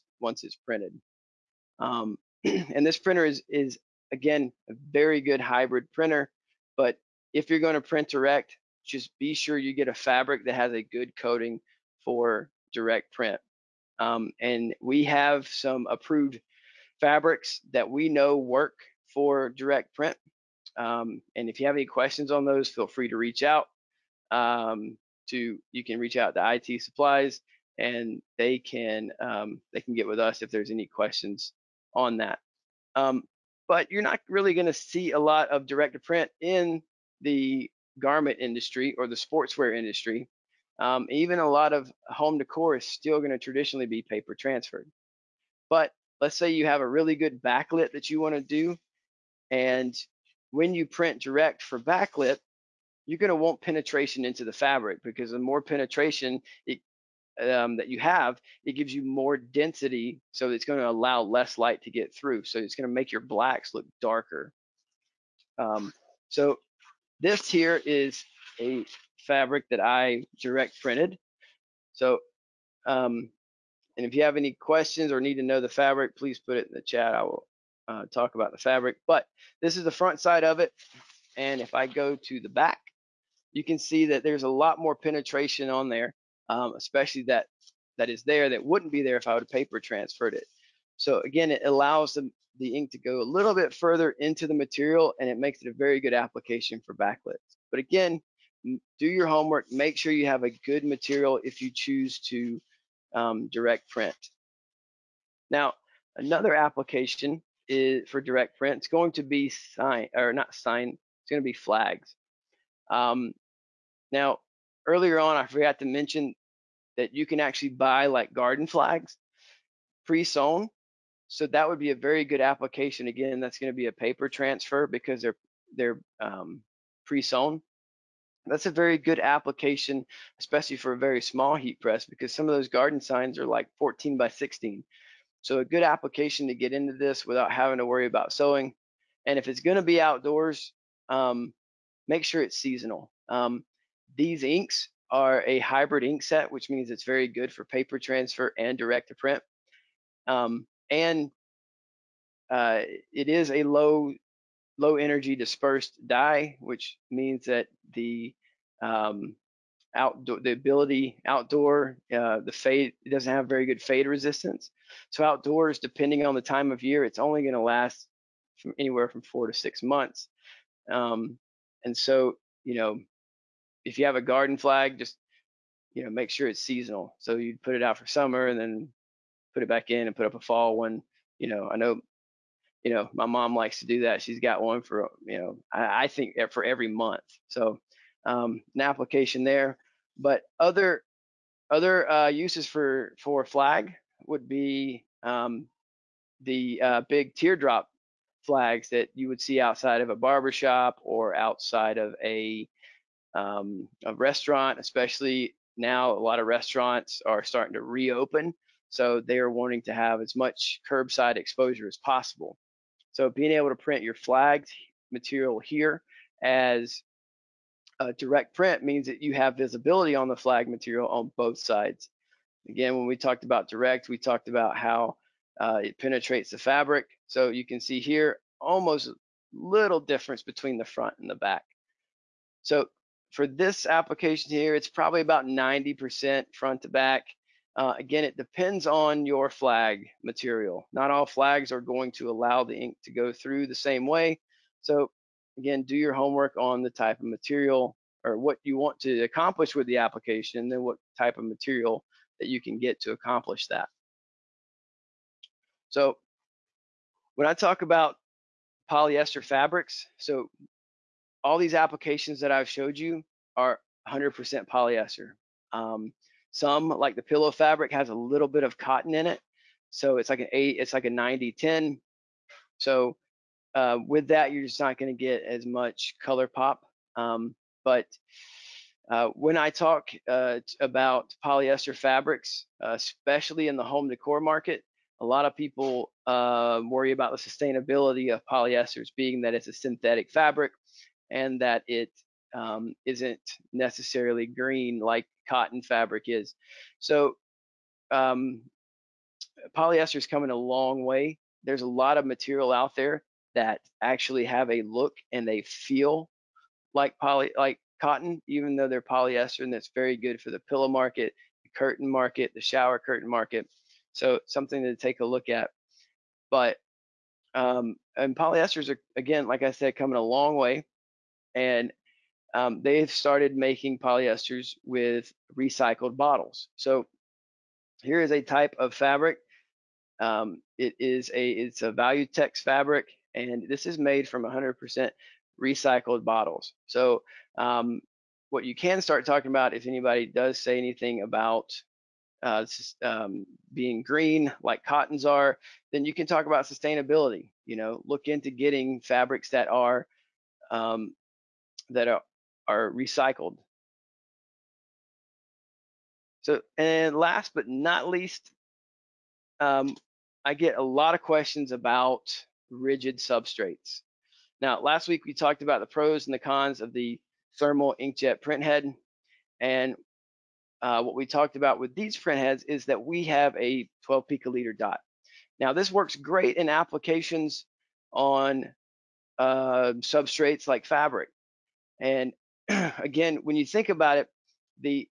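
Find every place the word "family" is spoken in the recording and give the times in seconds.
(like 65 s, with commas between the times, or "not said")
not said.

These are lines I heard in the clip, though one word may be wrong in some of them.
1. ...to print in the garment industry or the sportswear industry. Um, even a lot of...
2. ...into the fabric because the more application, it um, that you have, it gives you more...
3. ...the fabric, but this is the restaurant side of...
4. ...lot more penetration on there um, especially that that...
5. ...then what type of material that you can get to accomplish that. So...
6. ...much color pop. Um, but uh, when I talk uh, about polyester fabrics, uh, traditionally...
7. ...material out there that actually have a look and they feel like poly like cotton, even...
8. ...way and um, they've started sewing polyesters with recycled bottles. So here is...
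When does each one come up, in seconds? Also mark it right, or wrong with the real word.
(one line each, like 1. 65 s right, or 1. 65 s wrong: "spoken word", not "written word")
1. 35 s right
2. 54 s wrong: "penetration", not "application"
3. 78 s wrong: "front", not "restaurant"
4. 84 s right
5. 250 s right
6. 275 s wrong: "especially", not "traditionally"
7. 302 s right
8. 320 s wrong: "making", not "sewing".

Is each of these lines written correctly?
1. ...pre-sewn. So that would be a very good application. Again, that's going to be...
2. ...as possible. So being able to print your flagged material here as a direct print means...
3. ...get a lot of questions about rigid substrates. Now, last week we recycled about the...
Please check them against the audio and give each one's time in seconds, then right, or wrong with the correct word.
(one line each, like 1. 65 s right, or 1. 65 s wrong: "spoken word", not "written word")
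1. 120 s right
2. 211 s right
3. 360 s wrong: "talked", not "recycled".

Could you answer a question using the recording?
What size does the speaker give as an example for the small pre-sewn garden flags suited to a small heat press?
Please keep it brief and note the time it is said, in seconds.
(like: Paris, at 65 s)
14 by 16, at 133 s.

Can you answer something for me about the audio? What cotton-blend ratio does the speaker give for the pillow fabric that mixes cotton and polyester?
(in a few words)
90/10.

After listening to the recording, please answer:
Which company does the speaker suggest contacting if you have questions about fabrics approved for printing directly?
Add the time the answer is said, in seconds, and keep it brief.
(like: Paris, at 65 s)
IT supplies, at 26 s.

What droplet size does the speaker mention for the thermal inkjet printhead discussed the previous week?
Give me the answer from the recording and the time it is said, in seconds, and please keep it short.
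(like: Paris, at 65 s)
12 picoliter, at 374 s.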